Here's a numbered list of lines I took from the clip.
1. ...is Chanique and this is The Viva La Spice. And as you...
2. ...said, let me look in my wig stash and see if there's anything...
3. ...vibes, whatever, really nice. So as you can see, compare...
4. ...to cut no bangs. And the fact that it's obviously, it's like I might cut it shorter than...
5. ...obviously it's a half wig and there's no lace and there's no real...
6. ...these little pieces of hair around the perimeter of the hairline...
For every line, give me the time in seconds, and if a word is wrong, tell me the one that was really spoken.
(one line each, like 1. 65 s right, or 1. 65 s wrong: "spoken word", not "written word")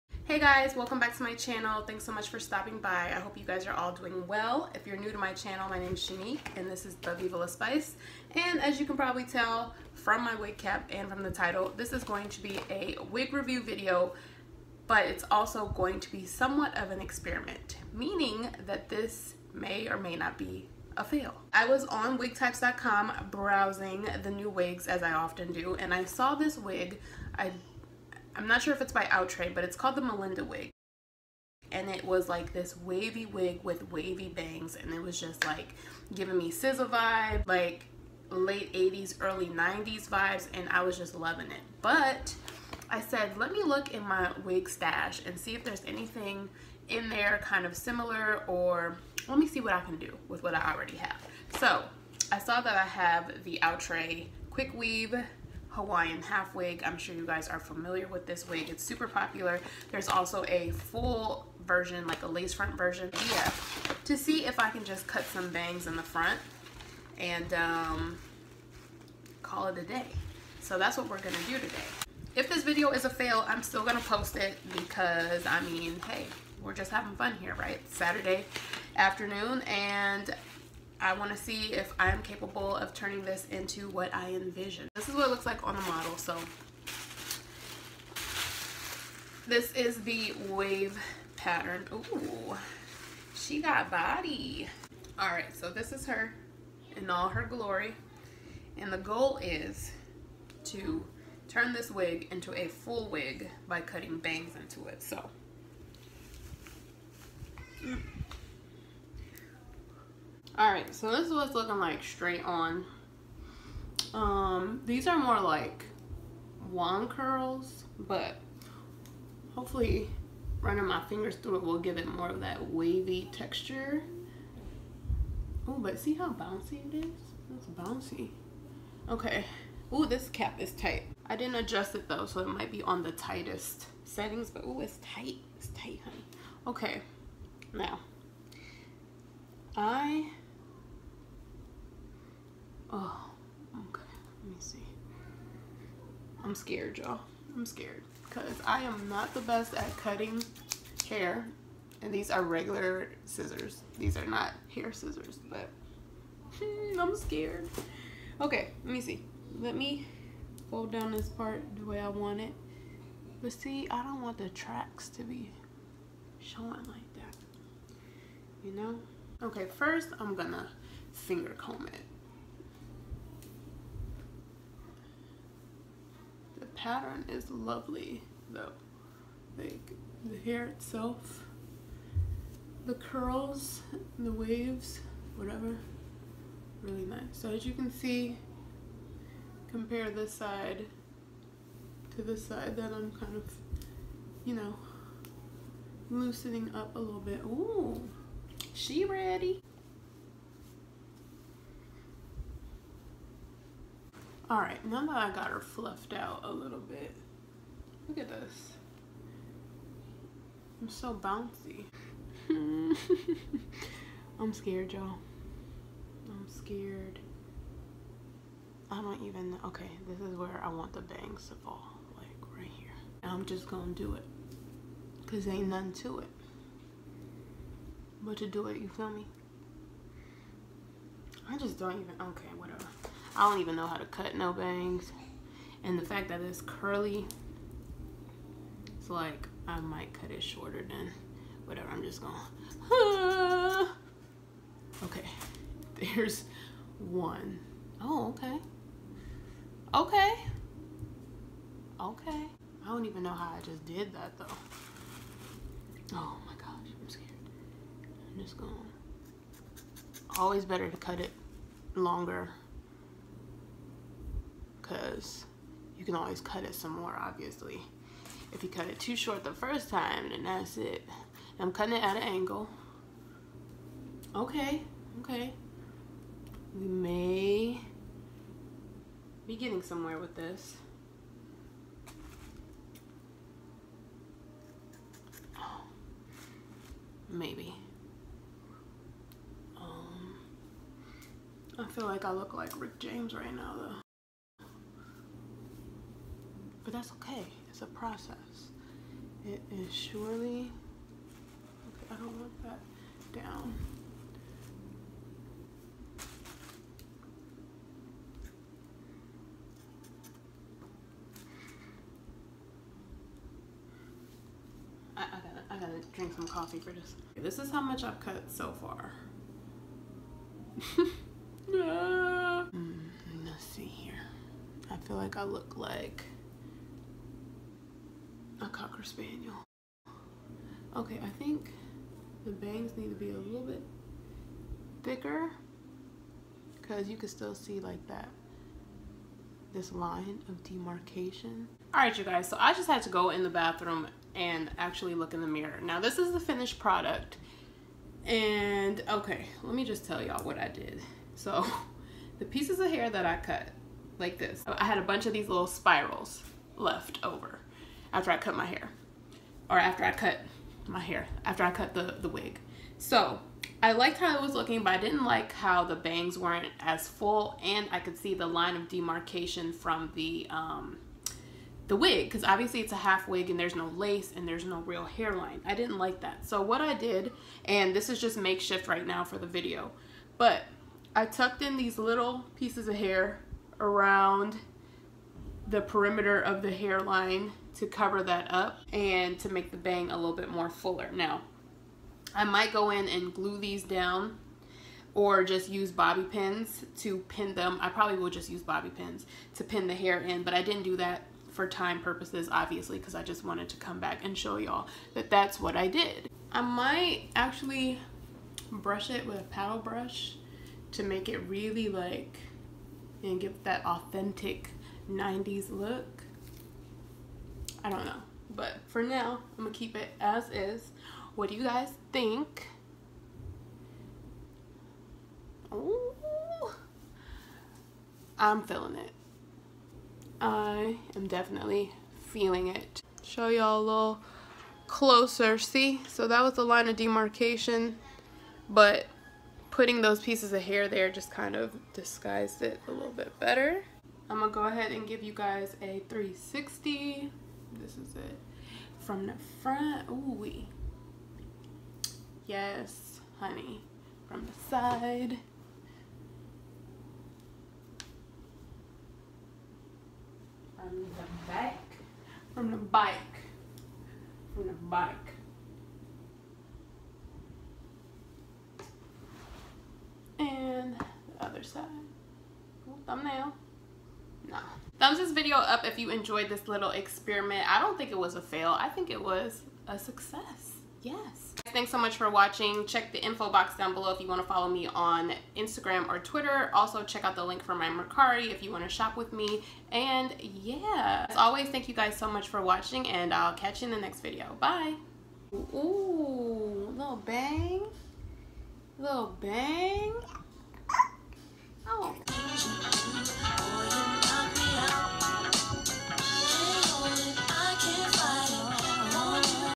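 1. 5 s right
2. 43 s right
3. 184 s wrong: "waves", not "vibes"
4. 233 s wrong: "curly", not "obviously"
5. 372 s right
6. 381 s right.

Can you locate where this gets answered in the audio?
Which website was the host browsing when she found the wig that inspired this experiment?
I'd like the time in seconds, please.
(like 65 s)
22 s.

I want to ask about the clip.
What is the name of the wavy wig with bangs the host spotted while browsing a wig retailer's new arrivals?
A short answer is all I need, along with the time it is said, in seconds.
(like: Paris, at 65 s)
Melinda, at 30 s.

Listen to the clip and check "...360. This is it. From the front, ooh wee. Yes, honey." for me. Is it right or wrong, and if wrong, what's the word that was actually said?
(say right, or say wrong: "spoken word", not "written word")
right.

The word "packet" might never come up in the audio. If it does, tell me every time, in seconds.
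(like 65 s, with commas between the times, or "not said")
not said.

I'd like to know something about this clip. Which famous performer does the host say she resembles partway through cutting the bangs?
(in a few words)
Rick James.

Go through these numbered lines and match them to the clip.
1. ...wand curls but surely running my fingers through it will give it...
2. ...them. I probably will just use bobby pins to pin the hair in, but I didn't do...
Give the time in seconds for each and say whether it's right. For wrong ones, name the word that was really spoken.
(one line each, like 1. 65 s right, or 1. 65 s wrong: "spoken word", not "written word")
1. 116 s wrong: "hopefully", not "surely"
2. 397 s right.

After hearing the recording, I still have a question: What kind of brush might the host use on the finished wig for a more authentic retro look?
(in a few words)
paddle brush.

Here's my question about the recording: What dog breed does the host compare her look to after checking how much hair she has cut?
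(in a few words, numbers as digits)
Cocker Spaniel.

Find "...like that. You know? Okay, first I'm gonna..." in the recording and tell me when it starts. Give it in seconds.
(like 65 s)
166 s.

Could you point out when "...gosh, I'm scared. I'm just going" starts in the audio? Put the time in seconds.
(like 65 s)
256 s.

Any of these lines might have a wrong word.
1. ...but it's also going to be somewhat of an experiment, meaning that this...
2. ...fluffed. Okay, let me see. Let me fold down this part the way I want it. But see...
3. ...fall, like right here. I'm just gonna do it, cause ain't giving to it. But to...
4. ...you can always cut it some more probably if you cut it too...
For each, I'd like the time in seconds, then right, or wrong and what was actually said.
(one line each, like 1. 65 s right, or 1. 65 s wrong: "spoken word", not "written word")
1. 14 s right
2. 157 s wrong: "scared", not "fluffed"
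3. 221 s wrong: "nothing", not "giving"
4. 265 s wrong: "obviously", not "probably".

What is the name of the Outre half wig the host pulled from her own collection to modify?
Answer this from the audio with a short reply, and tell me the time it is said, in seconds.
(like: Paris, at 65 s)
Quick Weave Hawaiian, at 54 s.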